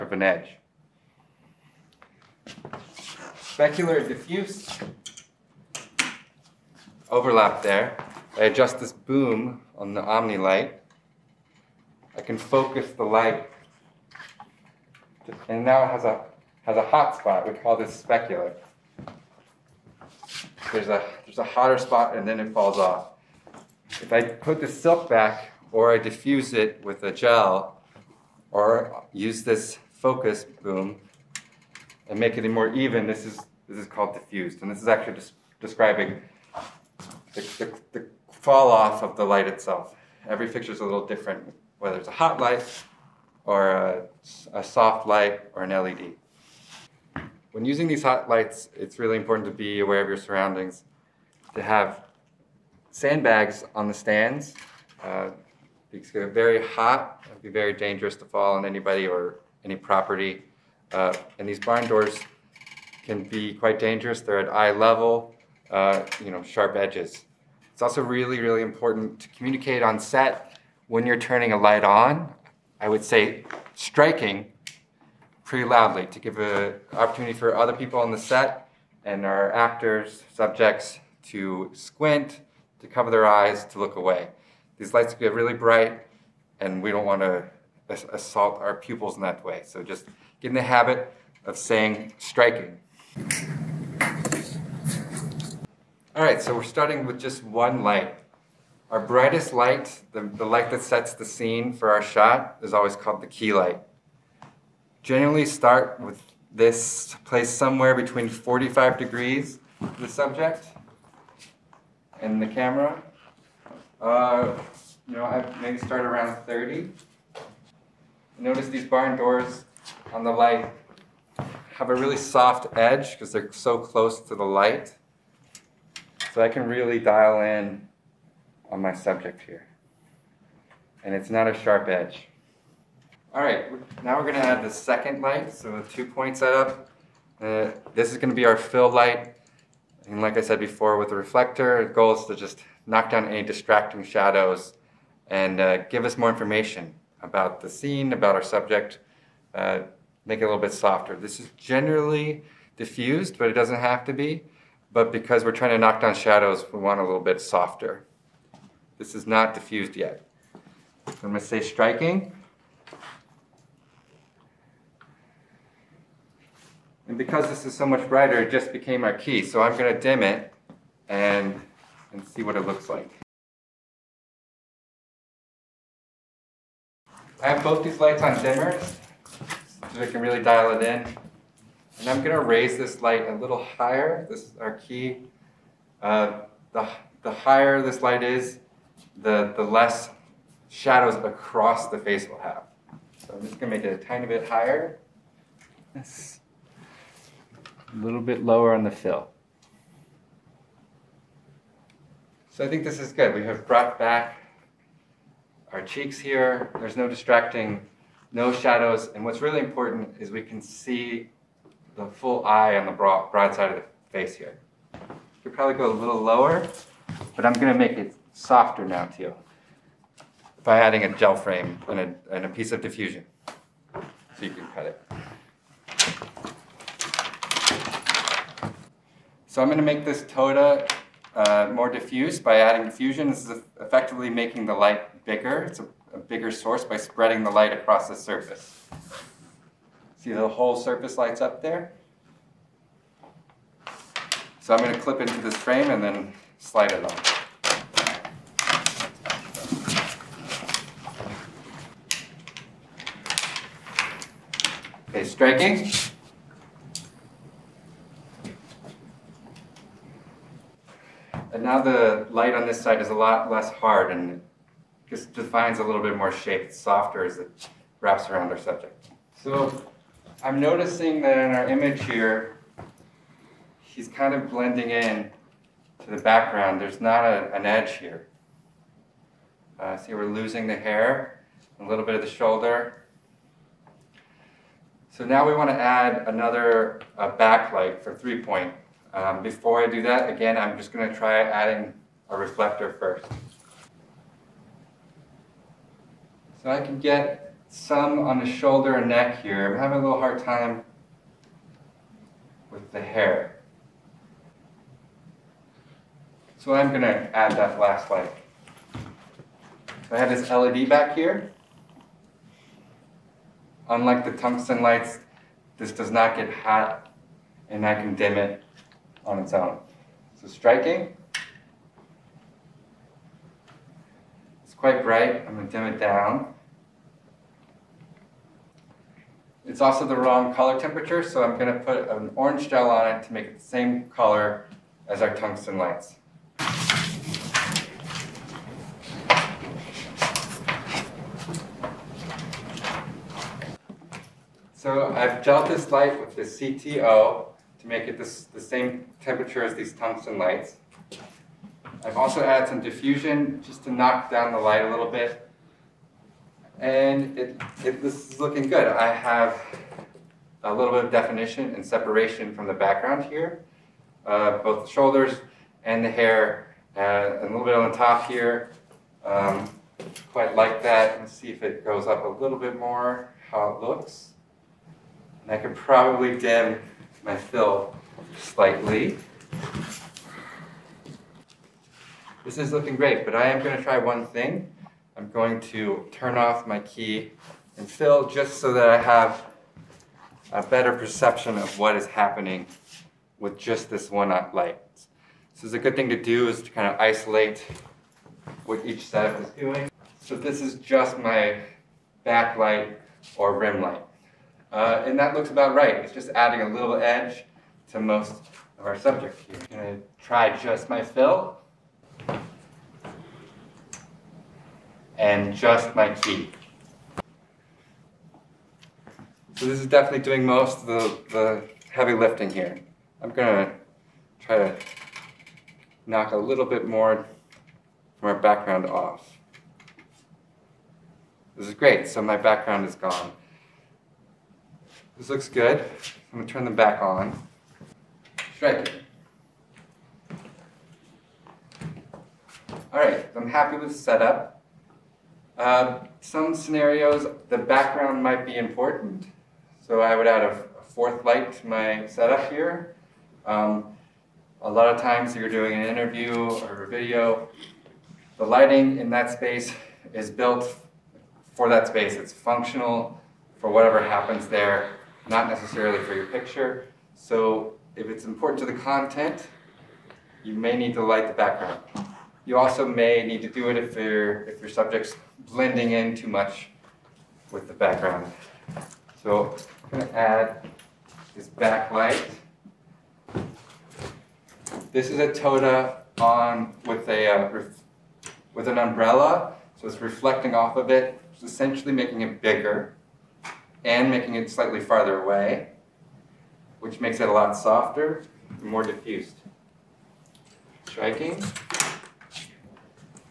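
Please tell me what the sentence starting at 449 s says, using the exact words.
So I would add a, a fourth light to my setup here.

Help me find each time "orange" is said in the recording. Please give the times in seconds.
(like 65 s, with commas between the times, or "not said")
332 s.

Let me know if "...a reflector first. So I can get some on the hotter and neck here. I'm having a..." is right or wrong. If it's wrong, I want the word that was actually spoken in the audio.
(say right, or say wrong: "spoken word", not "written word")
wrong: "shoulder", not "hotter".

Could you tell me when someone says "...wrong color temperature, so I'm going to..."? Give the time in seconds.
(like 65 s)
330 s.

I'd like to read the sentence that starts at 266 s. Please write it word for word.
It's softer as it wraps around our subject.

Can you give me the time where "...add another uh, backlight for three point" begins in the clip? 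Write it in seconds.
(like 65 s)
285 s.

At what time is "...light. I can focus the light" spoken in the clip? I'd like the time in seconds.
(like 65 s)
10 s.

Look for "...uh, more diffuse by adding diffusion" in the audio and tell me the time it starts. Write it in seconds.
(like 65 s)
231 s.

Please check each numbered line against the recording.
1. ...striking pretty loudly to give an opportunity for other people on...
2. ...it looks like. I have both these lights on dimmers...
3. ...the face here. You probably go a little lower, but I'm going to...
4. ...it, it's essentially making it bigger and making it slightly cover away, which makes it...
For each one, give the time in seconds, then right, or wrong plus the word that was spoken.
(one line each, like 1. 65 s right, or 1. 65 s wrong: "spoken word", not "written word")
1. 73 s right
2. 172 s right
3. 213 s right
4. 490 s wrong: "farther", not "cover".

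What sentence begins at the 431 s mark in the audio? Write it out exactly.
This is great, so my background is gone.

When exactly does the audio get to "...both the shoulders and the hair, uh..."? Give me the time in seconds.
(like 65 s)
364 s.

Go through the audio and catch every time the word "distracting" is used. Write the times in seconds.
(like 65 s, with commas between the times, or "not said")
143 s, 207 s.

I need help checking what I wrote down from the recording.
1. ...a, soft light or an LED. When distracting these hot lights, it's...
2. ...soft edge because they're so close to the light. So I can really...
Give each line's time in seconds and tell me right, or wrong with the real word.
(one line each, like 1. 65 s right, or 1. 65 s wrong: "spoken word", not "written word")
1. 44 s wrong: "using", not "distracting"
2. 122 s right.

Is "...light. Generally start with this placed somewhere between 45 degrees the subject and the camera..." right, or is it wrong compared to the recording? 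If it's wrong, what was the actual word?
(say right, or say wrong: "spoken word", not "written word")
right.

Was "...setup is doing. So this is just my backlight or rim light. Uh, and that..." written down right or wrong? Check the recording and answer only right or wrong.
right.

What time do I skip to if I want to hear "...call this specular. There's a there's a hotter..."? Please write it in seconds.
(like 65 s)
17 s.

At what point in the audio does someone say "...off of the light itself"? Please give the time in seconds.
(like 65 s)
38 s.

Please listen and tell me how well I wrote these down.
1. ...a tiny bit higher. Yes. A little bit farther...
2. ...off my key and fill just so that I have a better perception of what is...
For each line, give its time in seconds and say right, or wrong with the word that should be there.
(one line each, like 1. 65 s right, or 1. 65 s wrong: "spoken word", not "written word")
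1. 194 s wrong: "lower", not "farther"
2. 386 s right.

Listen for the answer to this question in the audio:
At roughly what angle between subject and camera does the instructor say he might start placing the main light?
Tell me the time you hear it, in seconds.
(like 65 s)
115 s.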